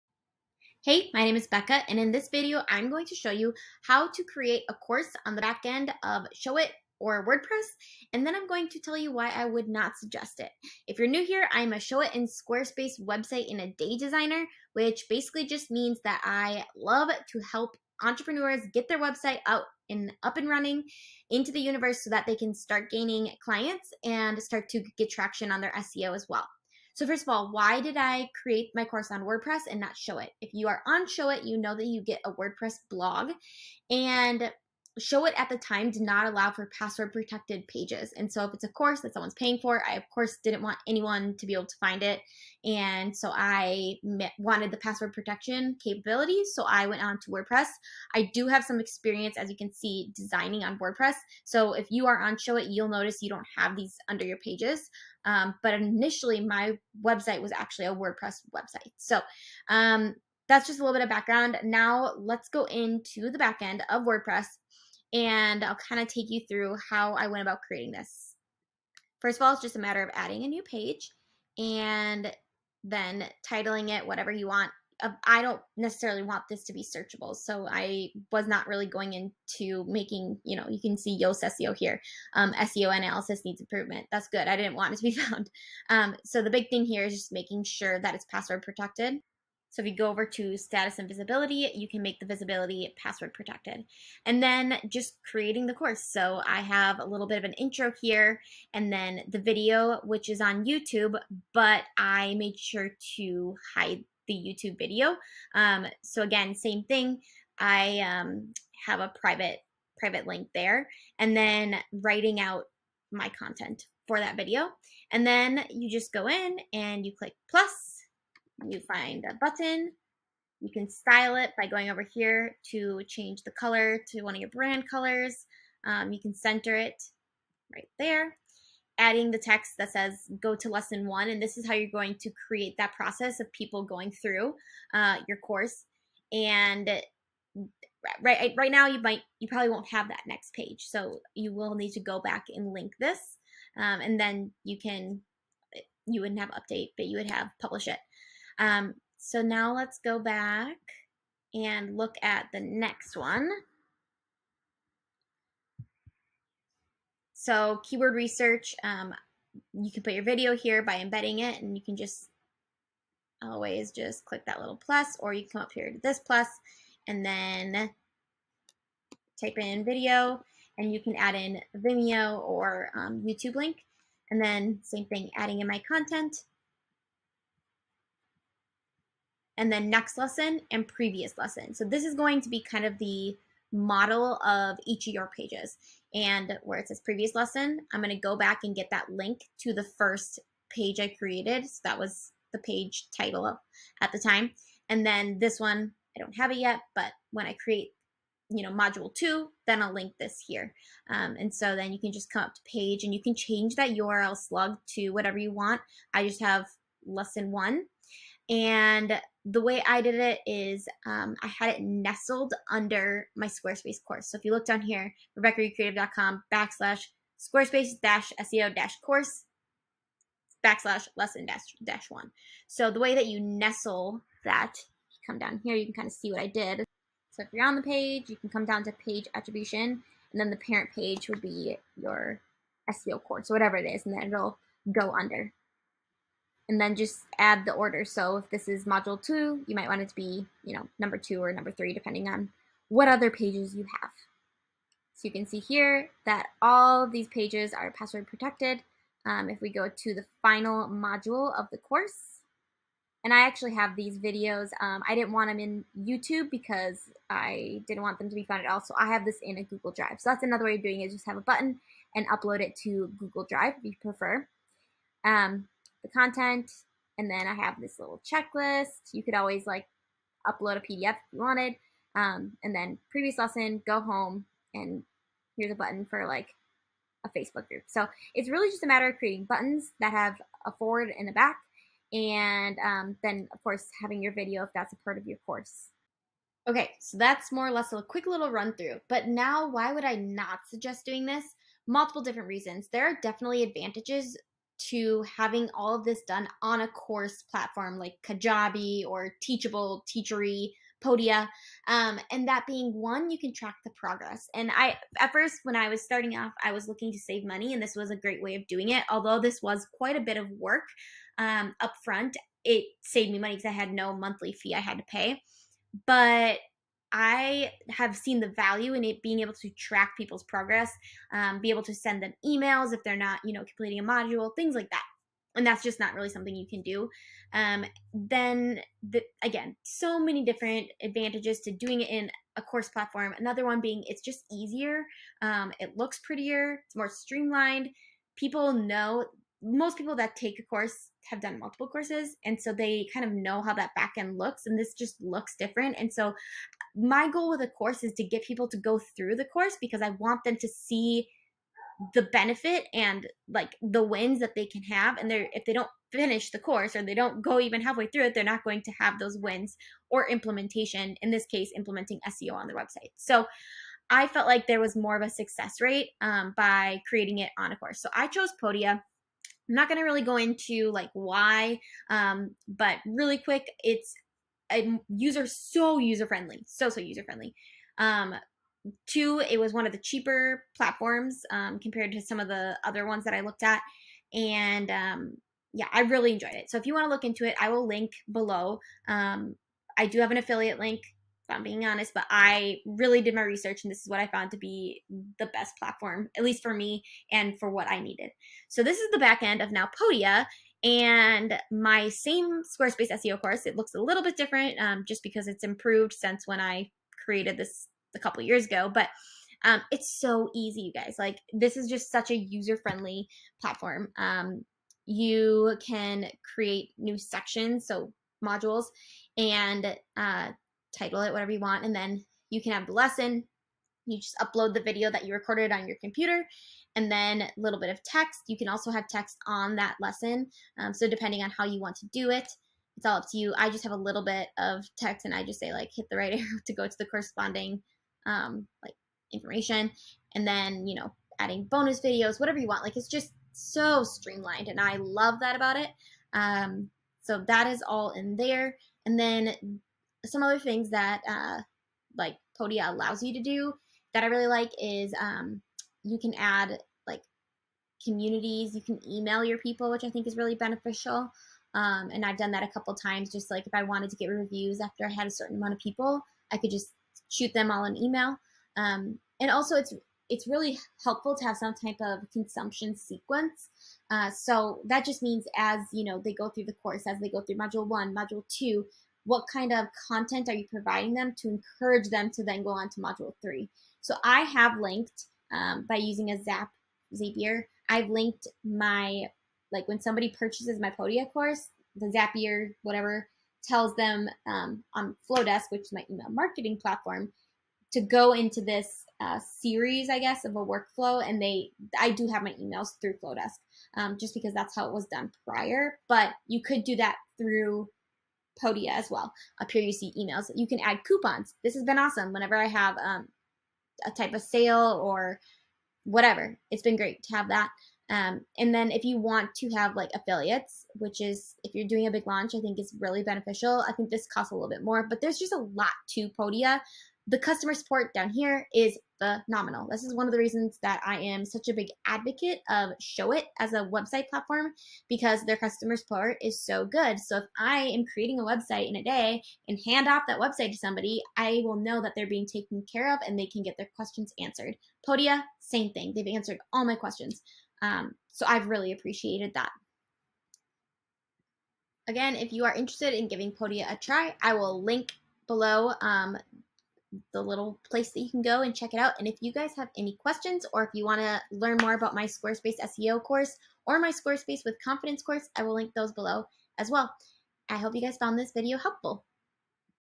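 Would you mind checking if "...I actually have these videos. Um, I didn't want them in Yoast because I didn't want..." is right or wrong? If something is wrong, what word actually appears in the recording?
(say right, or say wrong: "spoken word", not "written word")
wrong: "YouTube", not "Yoast".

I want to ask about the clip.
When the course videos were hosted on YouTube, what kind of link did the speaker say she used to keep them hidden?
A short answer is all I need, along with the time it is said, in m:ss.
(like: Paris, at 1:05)
private link, at 1:49.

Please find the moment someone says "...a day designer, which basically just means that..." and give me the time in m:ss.
0:13.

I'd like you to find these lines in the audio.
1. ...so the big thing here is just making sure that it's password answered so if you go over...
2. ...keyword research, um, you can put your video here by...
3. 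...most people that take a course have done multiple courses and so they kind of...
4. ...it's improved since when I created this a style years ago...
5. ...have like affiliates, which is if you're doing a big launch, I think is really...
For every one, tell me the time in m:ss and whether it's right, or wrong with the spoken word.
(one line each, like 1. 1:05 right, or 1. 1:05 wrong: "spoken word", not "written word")
1. 1:26 wrong: "protected", not "answered"
2. 2:37 right
3. 5:39 right
4. 6:45 wrong: "couple", not "style"
5. 8:39 right.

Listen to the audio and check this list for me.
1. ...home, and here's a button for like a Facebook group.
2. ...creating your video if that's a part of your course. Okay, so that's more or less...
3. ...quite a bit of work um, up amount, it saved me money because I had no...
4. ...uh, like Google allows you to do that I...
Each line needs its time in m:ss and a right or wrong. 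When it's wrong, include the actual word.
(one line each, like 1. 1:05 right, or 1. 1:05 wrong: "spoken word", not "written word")
1. 4:34 right
2. 4:44 wrong: "having", not "creating"
3. 5:09 wrong: "front", not "amount"
4. 7:31 wrong: "Podia", not "Google".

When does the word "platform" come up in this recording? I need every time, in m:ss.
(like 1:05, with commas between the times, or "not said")
4:57, 5:32, 6:20, 6:35, 6:53, 8:16, 8:54.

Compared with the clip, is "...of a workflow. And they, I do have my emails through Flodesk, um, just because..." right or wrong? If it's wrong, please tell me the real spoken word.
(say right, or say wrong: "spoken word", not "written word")
right.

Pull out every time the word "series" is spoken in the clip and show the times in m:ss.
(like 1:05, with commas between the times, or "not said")
8:19.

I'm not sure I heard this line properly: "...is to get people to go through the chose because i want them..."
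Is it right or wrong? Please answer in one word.
wrong.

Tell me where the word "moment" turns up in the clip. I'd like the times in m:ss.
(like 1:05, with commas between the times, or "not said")
not said.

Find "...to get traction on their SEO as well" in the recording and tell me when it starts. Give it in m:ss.
0:24.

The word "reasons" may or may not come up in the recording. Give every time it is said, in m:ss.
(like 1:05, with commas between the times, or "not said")
4:52, 8:50.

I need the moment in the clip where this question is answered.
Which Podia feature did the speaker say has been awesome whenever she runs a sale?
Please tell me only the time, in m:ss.
8:31.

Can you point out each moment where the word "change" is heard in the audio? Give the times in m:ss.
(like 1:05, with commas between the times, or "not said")
2:03, 3:23.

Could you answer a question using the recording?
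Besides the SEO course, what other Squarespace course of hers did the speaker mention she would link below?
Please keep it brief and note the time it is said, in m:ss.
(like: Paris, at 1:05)
Squarespace with Confidence, at 9:24.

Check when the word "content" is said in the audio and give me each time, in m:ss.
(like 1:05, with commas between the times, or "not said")
1:53, 2:55, 4:26, 8:00.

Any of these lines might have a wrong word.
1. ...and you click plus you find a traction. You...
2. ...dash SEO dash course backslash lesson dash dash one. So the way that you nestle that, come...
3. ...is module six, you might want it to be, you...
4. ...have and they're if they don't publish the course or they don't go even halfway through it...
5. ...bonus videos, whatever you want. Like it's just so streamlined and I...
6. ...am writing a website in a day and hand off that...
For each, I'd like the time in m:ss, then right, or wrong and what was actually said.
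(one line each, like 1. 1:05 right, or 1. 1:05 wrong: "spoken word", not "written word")
1. 1:56 wrong: "button", not "traction"
2. 3:38 right
3. 3:58 wrong: "two", not "six"
4. 5:54 wrong: "finish", not "publish"
5. 7:21 right
6. 8:57 wrong: "creating", not "writing".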